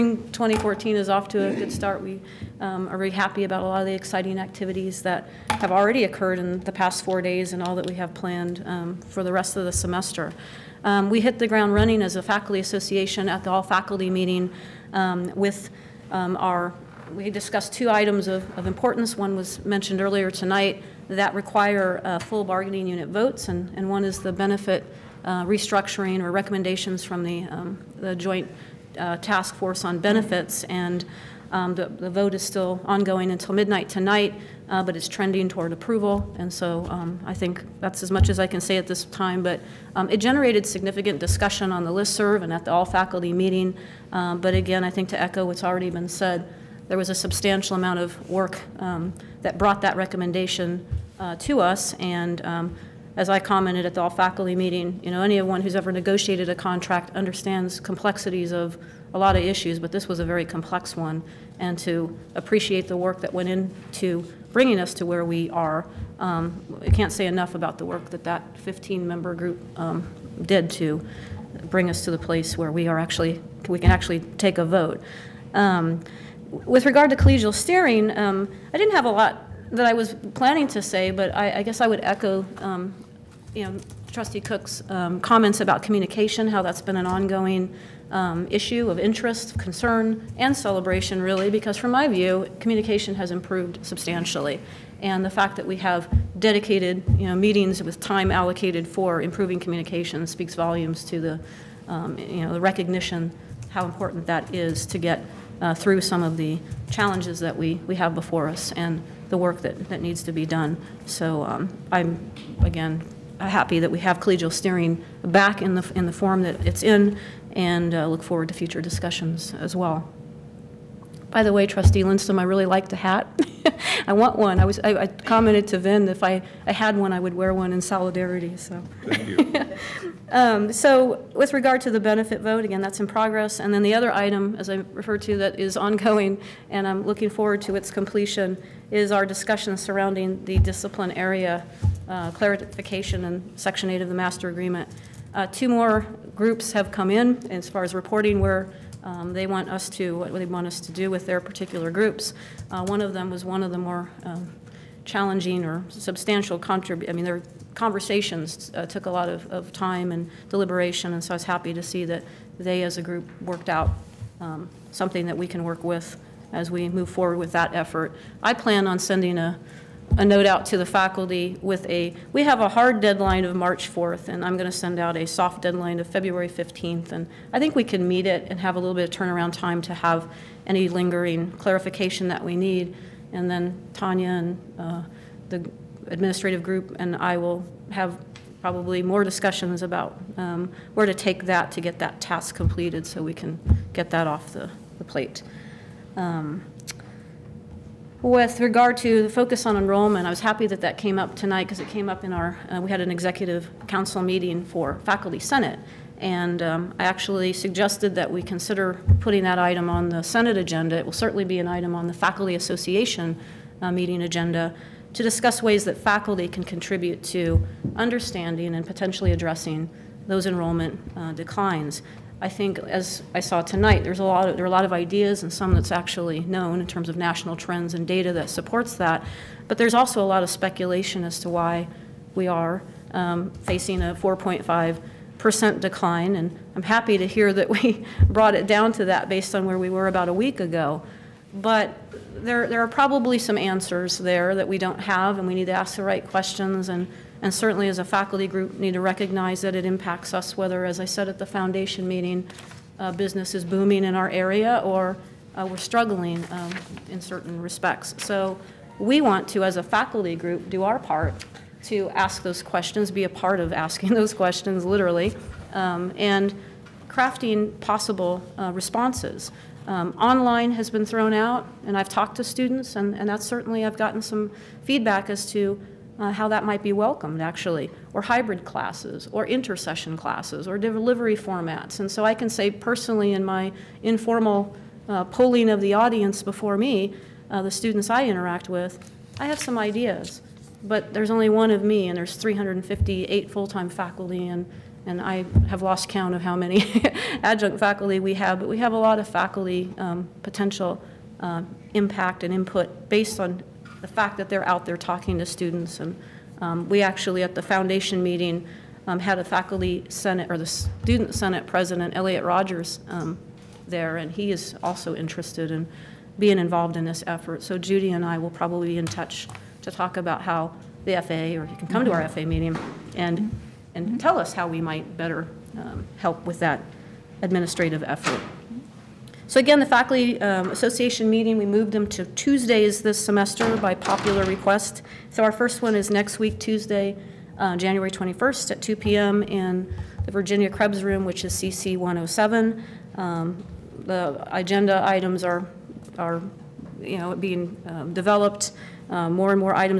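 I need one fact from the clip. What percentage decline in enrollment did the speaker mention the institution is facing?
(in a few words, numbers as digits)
4.5%.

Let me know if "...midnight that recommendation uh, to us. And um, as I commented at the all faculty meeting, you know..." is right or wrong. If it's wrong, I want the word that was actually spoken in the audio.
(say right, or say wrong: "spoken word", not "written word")
wrong: "brought", not "midnight".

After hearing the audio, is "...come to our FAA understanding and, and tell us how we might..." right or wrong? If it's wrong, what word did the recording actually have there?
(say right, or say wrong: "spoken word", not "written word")
wrong: "meeting", not "understanding".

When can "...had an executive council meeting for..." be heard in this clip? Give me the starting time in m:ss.
3:22.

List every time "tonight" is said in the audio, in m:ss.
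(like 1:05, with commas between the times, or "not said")
0:20, 0:33, 3:21, 3:43.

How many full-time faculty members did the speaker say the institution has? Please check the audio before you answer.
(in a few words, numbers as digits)
358.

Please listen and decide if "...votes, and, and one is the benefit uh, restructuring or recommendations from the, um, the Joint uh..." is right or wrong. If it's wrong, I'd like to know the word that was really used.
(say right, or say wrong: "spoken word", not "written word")
right.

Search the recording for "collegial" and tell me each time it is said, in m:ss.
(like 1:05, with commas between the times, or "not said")
1:17, 1:54.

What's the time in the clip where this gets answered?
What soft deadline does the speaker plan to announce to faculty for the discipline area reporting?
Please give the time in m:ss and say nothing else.
2:56.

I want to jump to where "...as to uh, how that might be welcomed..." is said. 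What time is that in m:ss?
4:35.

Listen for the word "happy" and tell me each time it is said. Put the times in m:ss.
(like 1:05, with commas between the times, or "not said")
0:03, 1:53, 2:41, 3:20, 3:56.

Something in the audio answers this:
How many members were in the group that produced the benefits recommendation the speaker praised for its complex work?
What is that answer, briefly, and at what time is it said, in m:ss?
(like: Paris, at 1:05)
15, at 1:08.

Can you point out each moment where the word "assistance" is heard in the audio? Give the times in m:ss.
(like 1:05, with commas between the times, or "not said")
not said.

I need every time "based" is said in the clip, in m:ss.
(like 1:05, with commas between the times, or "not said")
3:59, 5:03.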